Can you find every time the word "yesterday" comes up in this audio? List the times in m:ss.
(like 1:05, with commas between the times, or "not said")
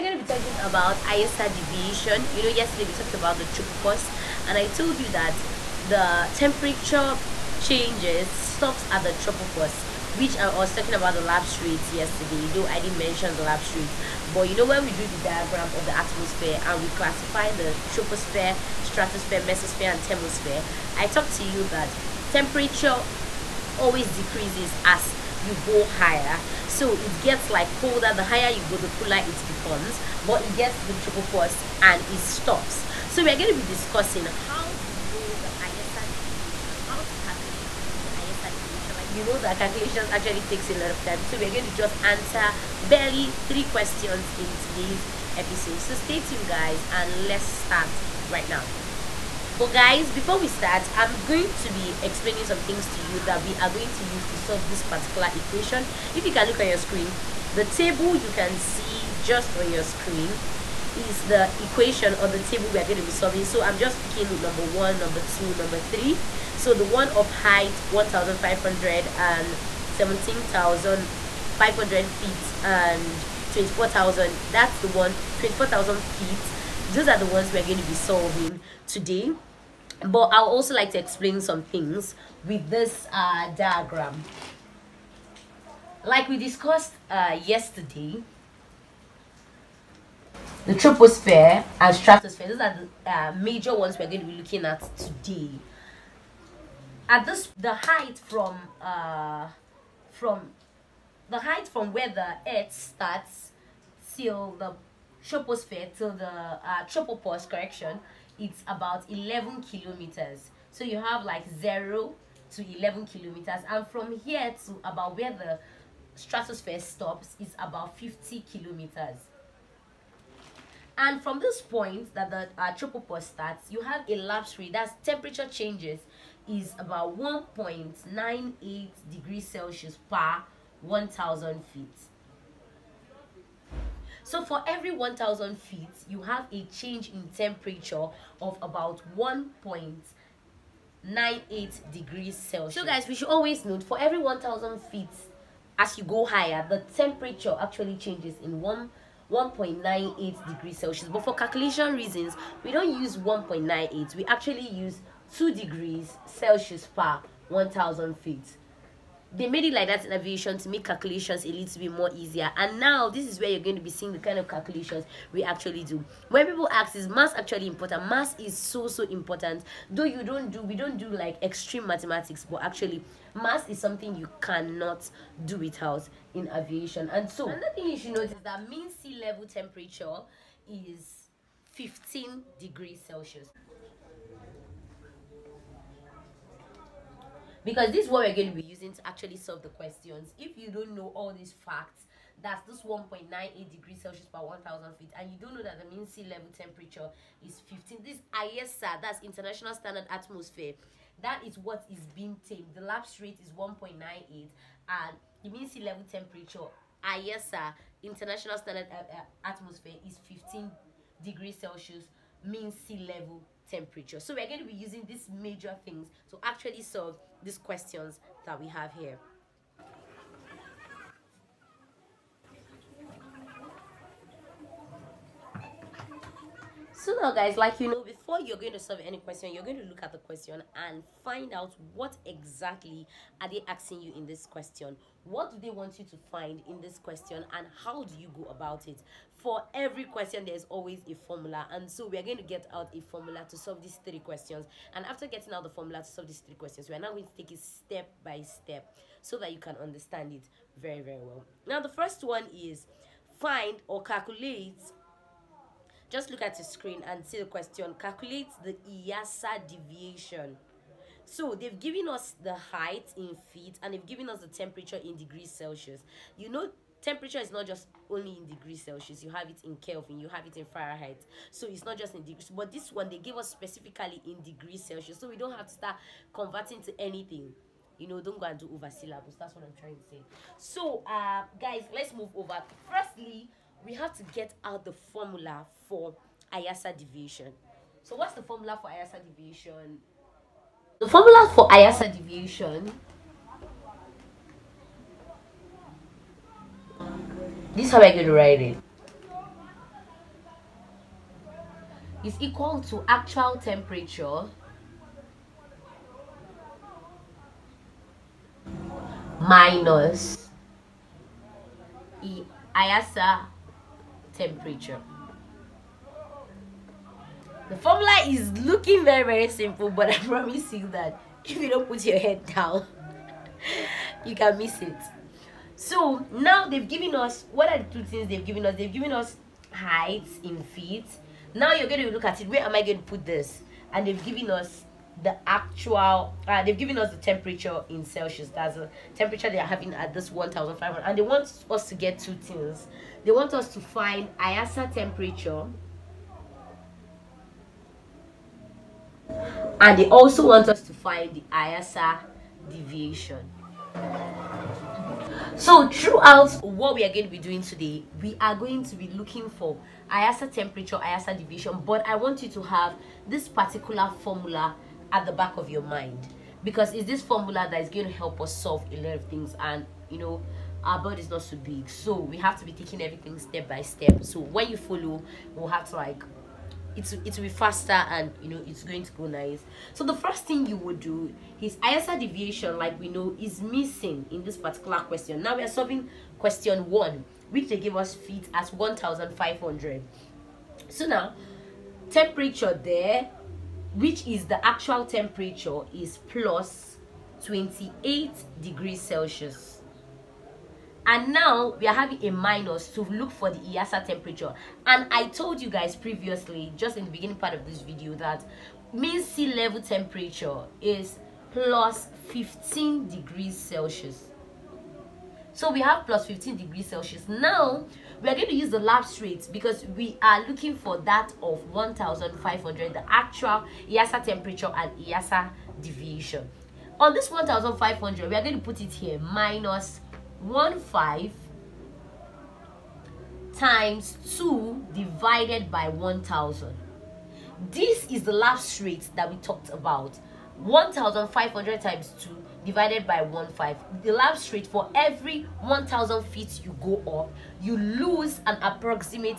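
0:02, 0:11, 1:27.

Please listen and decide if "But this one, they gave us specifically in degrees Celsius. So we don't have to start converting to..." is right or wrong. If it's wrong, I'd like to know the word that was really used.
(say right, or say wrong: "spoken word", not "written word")
right.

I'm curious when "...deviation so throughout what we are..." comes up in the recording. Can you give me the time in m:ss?
5:52.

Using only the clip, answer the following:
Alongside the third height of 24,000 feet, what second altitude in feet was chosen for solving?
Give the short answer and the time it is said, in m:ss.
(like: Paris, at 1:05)
17,500 feet, at 1:09.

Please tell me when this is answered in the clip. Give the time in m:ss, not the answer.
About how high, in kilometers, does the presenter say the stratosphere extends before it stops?
1:57.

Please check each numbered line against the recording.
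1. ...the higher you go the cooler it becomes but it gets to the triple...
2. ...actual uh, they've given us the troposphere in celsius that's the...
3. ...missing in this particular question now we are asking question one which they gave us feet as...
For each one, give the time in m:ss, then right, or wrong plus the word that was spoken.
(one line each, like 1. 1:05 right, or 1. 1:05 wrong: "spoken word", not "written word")
1. 0:28 right
2. 5:35 wrong: "temperature", not "troposphere"
3. 6:23 wrong: "solving", not "asking".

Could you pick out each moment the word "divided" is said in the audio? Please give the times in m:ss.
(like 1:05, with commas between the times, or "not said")
7:14, 7:22.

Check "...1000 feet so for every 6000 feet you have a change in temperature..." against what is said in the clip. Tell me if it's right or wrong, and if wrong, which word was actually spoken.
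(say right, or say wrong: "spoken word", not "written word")
wrong: "1000", not "6000".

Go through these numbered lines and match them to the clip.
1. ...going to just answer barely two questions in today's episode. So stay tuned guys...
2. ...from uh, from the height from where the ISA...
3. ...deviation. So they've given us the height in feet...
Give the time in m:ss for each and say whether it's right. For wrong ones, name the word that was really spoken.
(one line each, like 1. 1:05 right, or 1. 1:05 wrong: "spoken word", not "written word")
1. 0:41 wrong: "three", not "two"
2. 1:38 wrong: "Earth", not "ISA"
3. 4:19 right.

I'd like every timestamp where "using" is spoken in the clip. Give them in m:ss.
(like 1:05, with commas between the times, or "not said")
3:08, 3:34.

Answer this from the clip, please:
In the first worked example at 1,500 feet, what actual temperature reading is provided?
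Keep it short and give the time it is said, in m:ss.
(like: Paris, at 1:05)
+28 degrees Celsius, at 6:36.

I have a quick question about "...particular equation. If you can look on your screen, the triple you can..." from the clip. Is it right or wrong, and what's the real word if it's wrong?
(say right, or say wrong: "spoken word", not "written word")
wrong: "table", not "triple".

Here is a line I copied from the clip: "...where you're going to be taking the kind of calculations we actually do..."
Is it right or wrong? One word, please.
wrong.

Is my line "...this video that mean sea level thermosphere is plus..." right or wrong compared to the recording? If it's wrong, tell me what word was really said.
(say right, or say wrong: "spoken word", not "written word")
wrong: "temperature", not "thermosphere".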